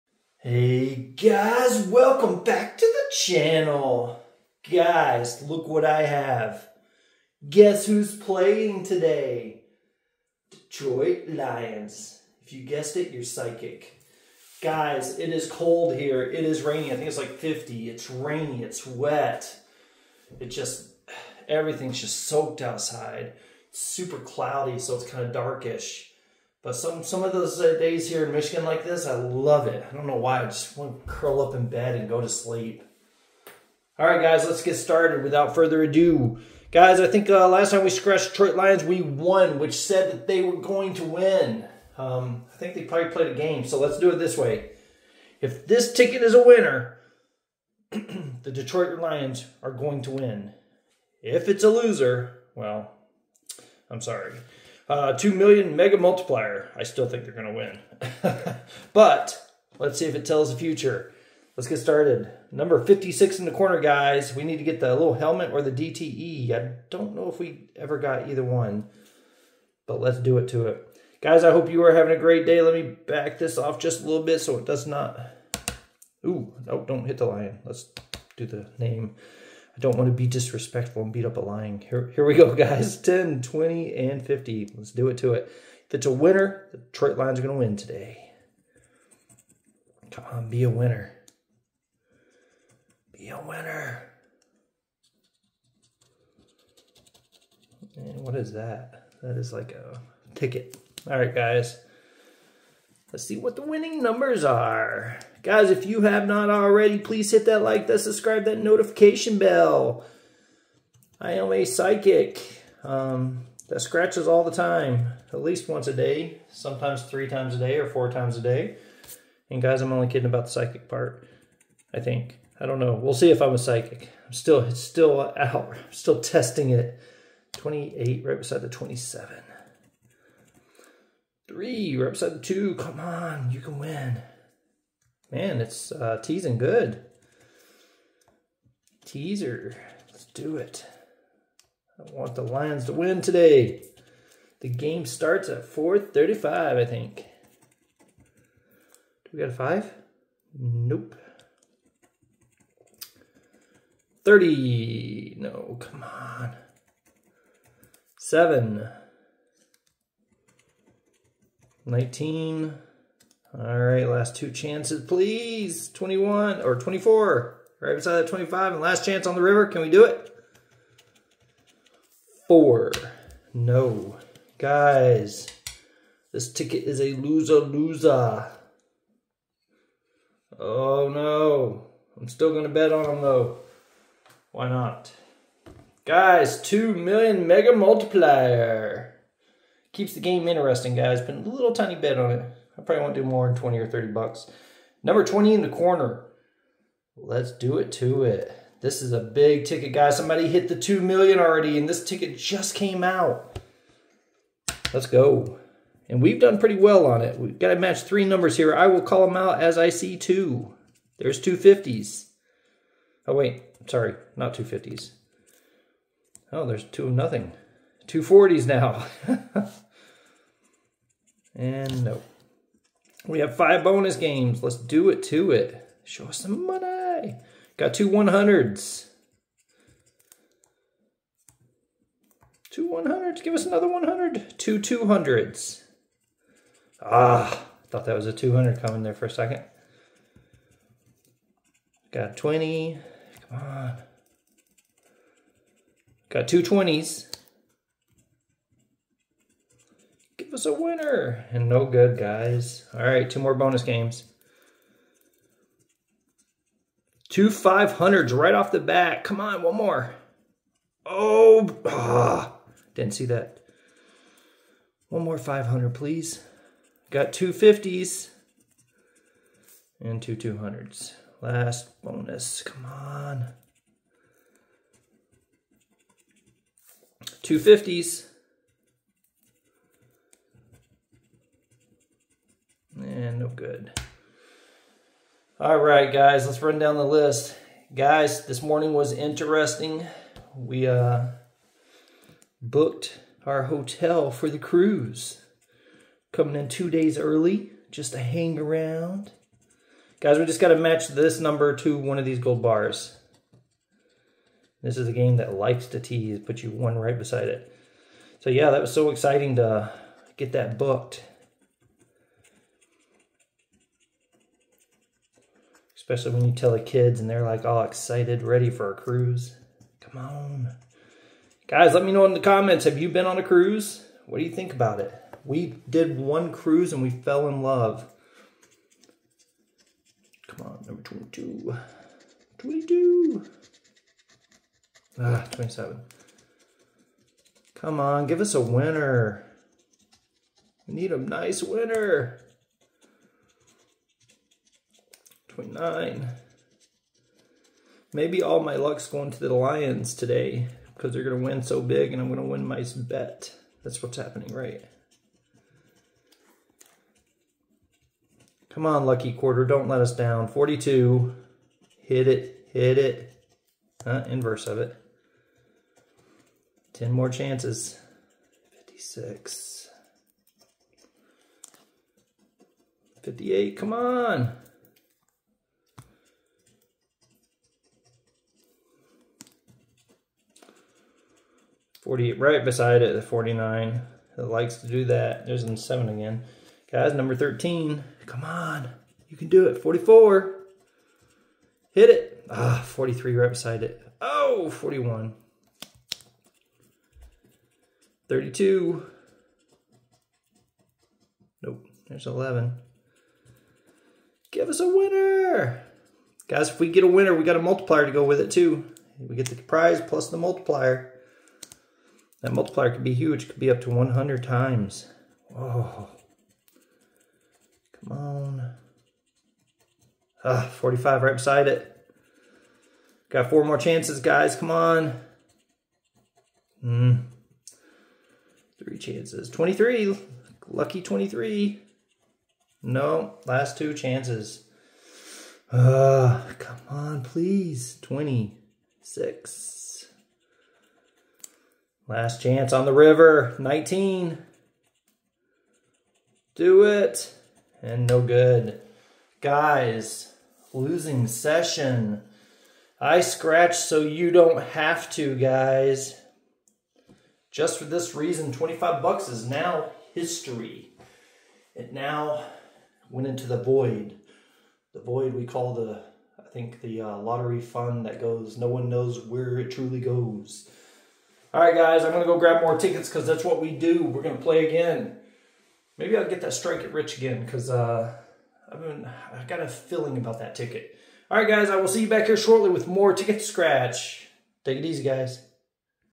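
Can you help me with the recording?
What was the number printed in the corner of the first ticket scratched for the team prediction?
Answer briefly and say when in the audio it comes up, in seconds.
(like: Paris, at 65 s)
56, at 62 s.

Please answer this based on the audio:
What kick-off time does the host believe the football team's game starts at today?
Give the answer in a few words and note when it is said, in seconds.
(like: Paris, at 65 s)
4:35, at 145 s.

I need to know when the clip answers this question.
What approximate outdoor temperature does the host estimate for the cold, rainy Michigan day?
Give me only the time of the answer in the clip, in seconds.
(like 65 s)
16 s.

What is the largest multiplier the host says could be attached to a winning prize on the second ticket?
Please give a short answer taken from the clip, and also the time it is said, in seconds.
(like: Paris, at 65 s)
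100 times, at 413 s.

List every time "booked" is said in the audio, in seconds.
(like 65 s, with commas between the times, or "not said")
292 s, 310 s.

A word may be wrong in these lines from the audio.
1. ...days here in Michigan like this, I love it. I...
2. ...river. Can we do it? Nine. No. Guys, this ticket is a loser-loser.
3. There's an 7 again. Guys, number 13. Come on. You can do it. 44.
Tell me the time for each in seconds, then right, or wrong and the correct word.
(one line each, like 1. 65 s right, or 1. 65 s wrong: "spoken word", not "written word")
1. 27 s right
2. 169 s wrong: "Four", not "Nine"
3. 385 s right.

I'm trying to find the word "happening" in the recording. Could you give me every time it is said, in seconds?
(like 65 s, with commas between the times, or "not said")
354 s.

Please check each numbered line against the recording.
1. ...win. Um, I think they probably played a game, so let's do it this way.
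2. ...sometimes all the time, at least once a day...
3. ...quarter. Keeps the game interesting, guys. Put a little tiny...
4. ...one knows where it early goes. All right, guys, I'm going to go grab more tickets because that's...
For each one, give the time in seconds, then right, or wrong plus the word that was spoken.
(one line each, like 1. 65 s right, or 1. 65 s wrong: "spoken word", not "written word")
1. 41 s right
2. 113 s wrong: "scratches", not "sometimes"
3. 187 s wrong: "multiplier", not "quarter"
4. 468 s wrong: "truly", not "early".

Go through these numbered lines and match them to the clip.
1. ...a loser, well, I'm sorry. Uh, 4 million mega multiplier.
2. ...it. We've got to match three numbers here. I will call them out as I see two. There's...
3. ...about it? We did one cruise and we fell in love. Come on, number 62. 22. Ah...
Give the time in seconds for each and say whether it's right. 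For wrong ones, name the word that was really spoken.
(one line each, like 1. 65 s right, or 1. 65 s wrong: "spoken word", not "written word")
1. 51 s wrong: "2", not "4"
2. 207 s right
3. 324 s wrong: "22", not "62".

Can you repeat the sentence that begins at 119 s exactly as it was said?
And guys, I'm only kidding about the psychic part, I think.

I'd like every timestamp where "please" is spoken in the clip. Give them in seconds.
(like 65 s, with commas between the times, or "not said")
106 s, 165 s, 265 s, 437 s.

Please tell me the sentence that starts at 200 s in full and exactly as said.
Somebody hit the 2 million already, and this ticket just came out.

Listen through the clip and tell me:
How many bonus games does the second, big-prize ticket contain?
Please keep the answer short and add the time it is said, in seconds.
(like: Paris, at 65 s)
5, at 223 s.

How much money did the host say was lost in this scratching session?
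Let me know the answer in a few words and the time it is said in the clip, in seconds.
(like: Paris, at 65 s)
$25, at 458 s.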